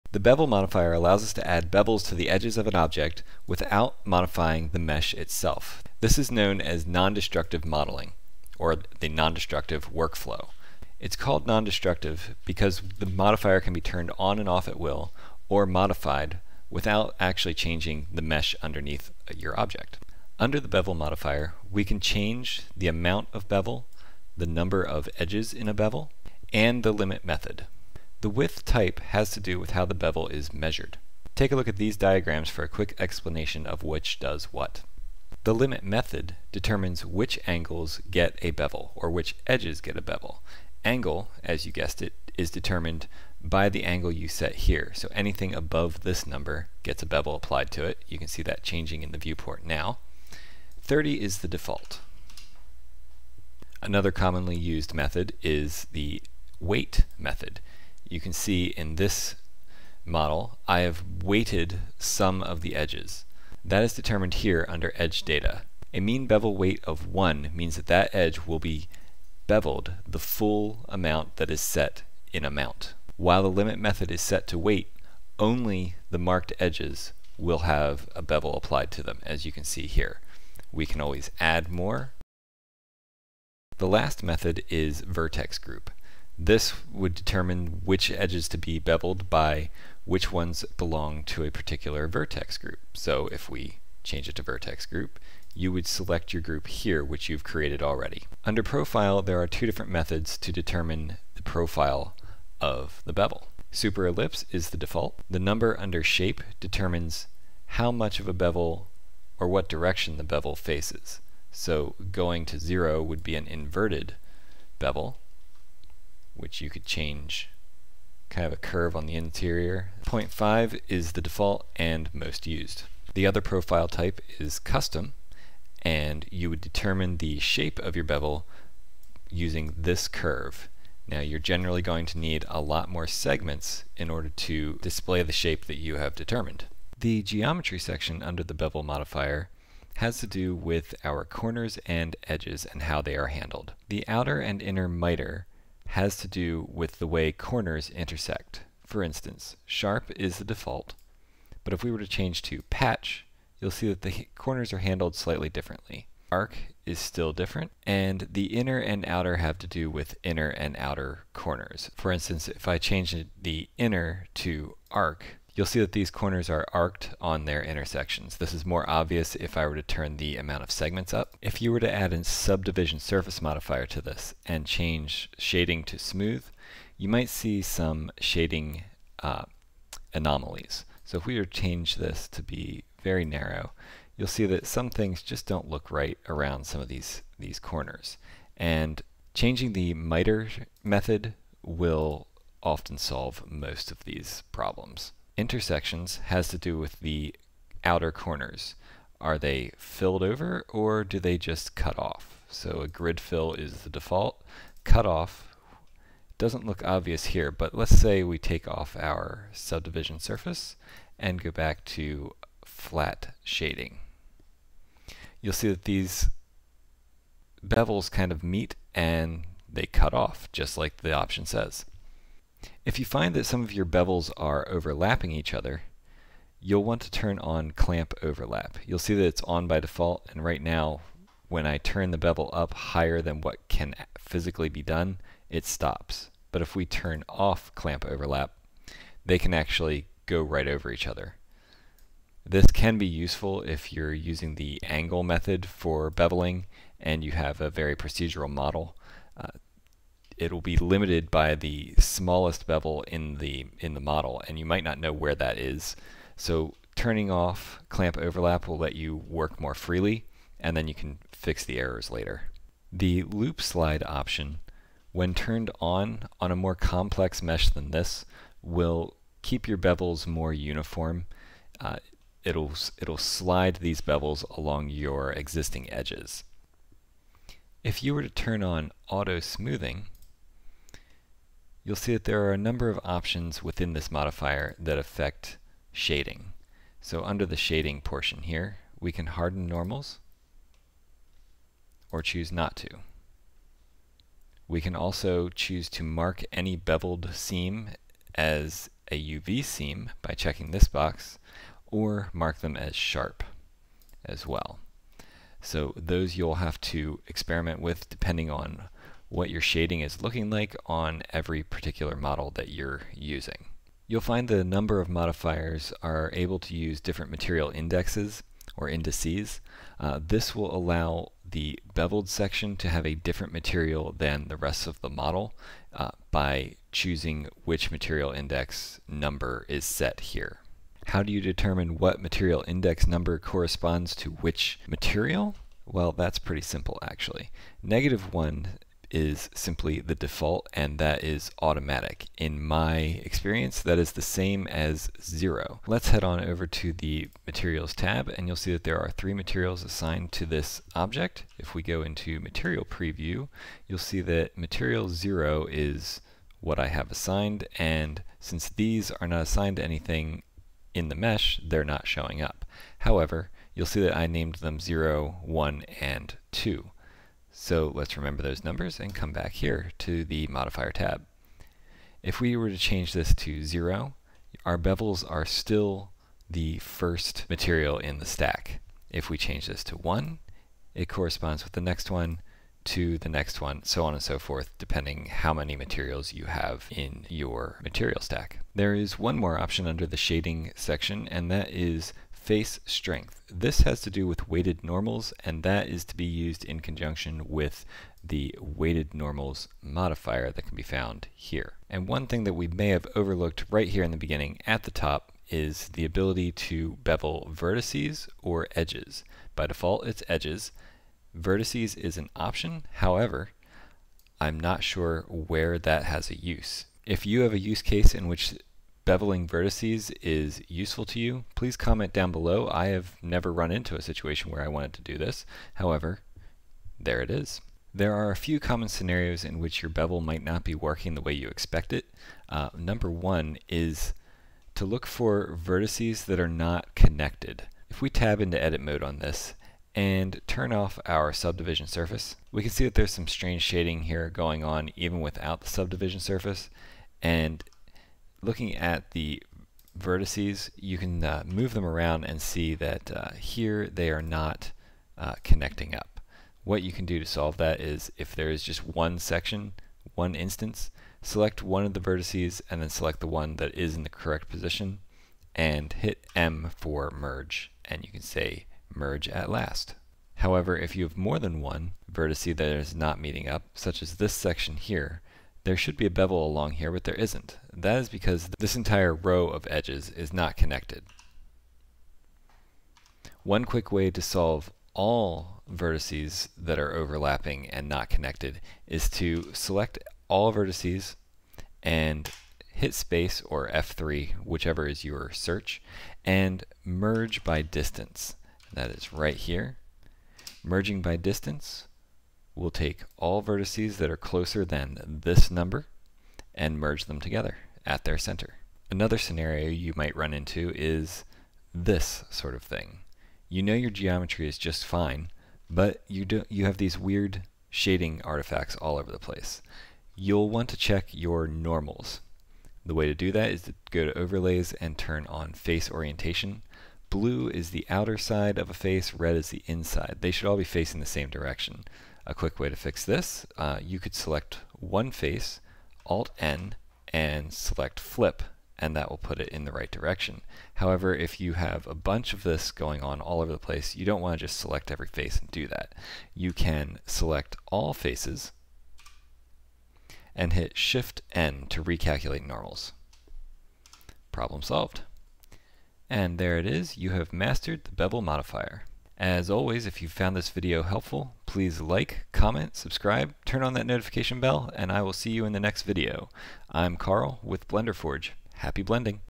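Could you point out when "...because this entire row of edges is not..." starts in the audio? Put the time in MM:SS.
07:58.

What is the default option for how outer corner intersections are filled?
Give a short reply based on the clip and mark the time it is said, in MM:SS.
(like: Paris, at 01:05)
grid fill, at 03:22.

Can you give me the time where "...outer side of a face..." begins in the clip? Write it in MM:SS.
08:47.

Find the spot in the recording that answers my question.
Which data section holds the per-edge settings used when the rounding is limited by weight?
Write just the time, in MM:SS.
01:04.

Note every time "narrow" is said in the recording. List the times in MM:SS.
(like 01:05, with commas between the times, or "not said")
03:03.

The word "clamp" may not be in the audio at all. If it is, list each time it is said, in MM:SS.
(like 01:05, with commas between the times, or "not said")
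03:47, 03:57, 04:17.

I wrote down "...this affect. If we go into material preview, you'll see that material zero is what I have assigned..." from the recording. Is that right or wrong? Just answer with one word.
wrong.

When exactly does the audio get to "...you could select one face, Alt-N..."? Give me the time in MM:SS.
08:53.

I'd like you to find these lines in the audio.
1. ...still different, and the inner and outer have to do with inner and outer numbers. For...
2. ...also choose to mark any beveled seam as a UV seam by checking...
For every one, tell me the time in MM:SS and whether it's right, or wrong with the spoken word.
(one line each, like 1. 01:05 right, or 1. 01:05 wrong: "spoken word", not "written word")
1. 02:36 wrong: "corners", not "numbers"
2. 04:54 right.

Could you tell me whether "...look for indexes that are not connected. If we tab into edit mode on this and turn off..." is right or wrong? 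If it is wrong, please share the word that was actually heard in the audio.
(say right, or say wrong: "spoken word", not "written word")
wrong: "vertices", not "indexes".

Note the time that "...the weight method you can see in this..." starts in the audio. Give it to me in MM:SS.
00:55.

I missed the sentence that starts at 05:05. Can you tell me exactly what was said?
So those you'll have to experiment with depending on what your shading is looking like on every particular model that you're using.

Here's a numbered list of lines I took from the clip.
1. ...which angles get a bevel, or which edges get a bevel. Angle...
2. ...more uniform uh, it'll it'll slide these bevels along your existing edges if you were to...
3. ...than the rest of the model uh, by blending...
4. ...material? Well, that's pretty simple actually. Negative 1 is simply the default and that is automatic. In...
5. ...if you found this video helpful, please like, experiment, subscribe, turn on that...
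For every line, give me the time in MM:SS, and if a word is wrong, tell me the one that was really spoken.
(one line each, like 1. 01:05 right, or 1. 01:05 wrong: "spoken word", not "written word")
1. 00:37 right
2. 04:30 right
3. 05:24 wrong: "choosing", not "blending"
4. 05:34 right
5. 09:19 wrong: "comment", not "experiment".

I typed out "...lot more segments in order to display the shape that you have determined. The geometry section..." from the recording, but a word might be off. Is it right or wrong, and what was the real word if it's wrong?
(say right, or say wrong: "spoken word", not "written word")
right.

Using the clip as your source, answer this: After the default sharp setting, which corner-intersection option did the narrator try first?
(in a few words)
patch.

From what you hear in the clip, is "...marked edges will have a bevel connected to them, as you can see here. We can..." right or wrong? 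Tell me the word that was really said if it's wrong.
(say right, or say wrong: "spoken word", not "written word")
wrong: "applied", not "connected".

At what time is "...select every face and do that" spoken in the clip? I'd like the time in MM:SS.
09:04.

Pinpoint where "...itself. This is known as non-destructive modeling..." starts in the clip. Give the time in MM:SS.
00:05.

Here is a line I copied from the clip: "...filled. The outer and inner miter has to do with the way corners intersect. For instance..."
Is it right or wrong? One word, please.
wrong.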